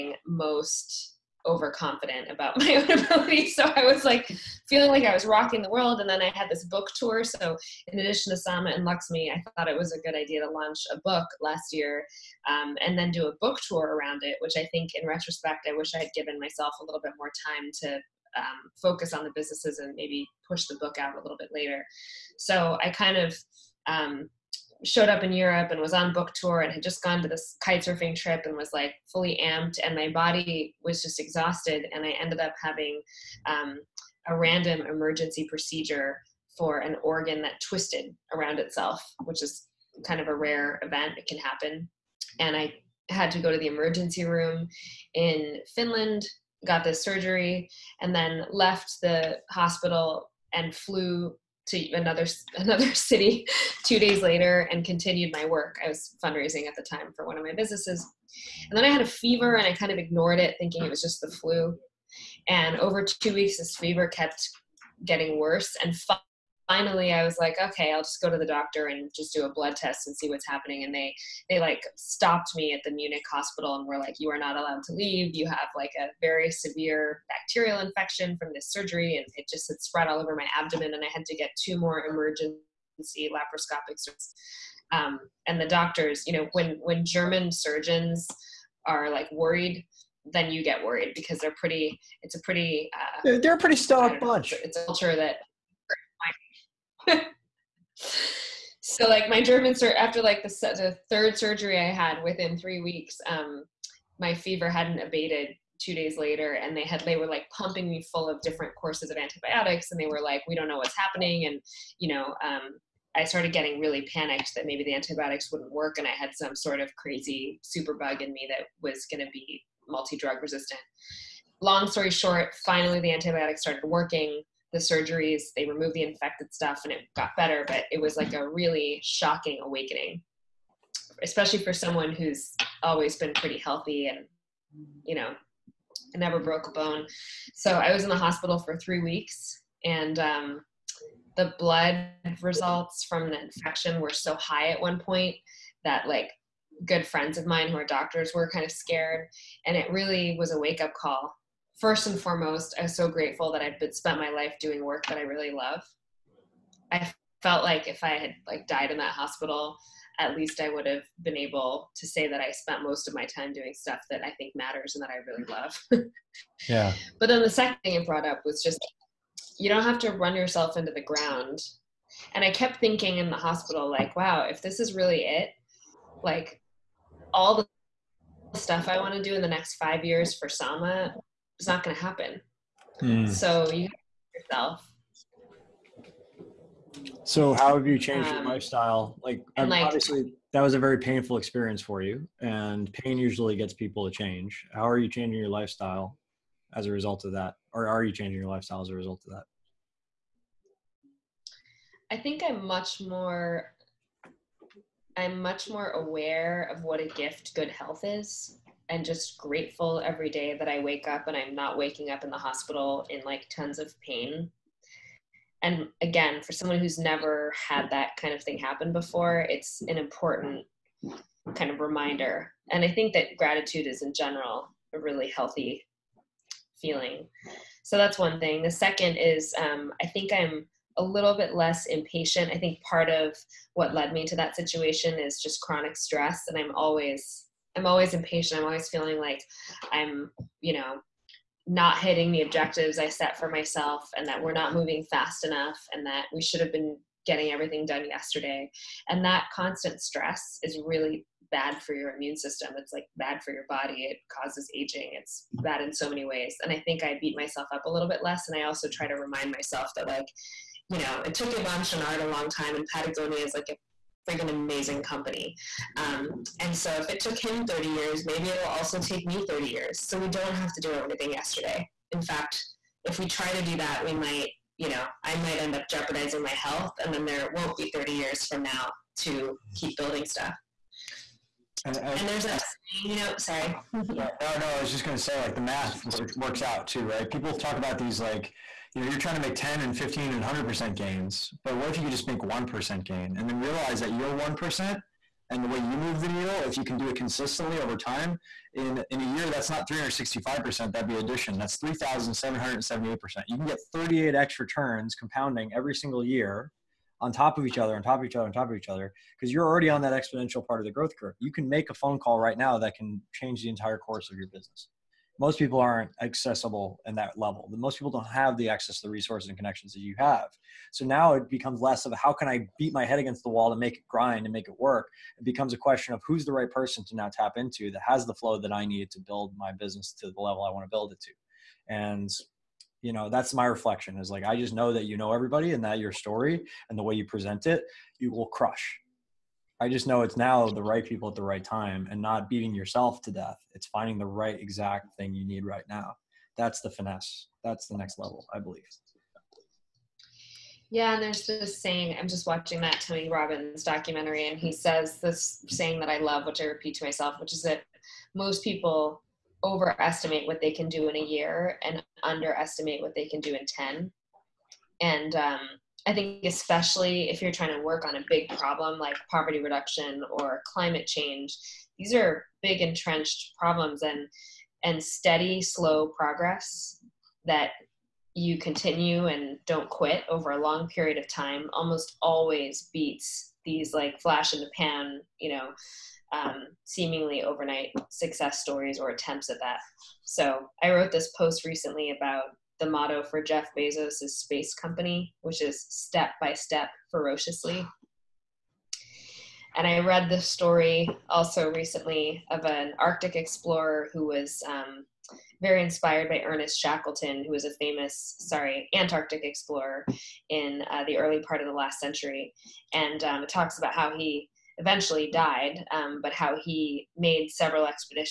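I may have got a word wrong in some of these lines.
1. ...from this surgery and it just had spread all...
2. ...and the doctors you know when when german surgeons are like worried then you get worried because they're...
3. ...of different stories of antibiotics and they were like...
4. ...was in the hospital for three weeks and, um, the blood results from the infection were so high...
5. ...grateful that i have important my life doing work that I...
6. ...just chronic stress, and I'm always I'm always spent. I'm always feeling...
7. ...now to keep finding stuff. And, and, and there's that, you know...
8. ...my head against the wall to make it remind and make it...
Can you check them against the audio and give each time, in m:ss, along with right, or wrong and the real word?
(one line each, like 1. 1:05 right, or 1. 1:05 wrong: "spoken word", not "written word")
1. 1:18 right
2. 1:25 right
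3. 1:48 wrong: "courses", not "stories"
4. 2:17 right
5. 2:33 wrong: "spent", not "important"
6. 3:55 wrong: "impatient", not "spent"
7. 4:38 wrong: "building", not "finding"
8. 5:22 wrong: "grind", not "remind".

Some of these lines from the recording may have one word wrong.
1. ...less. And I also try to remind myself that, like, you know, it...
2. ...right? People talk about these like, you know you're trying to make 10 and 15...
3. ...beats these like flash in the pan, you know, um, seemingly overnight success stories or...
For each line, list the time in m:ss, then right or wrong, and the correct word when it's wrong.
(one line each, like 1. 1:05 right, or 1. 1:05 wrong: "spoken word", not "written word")
1. 4:18 right
2. 4:47 right
3. 6:22 right.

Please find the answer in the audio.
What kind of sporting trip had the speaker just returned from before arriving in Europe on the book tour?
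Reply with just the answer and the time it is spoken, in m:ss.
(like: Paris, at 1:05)
kitesurfing, at 0:27.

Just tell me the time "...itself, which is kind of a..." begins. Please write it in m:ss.
0:38.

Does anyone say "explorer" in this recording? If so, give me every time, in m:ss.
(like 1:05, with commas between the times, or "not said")
6:43, 6:49.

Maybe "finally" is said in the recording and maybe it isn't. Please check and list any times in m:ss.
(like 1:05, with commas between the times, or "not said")
1:06, 2:02.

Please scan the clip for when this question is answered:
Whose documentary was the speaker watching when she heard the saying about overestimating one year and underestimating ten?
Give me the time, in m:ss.
5:52.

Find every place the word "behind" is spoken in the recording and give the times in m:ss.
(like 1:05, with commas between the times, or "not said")
not said.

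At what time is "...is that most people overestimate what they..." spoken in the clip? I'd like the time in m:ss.
5:57.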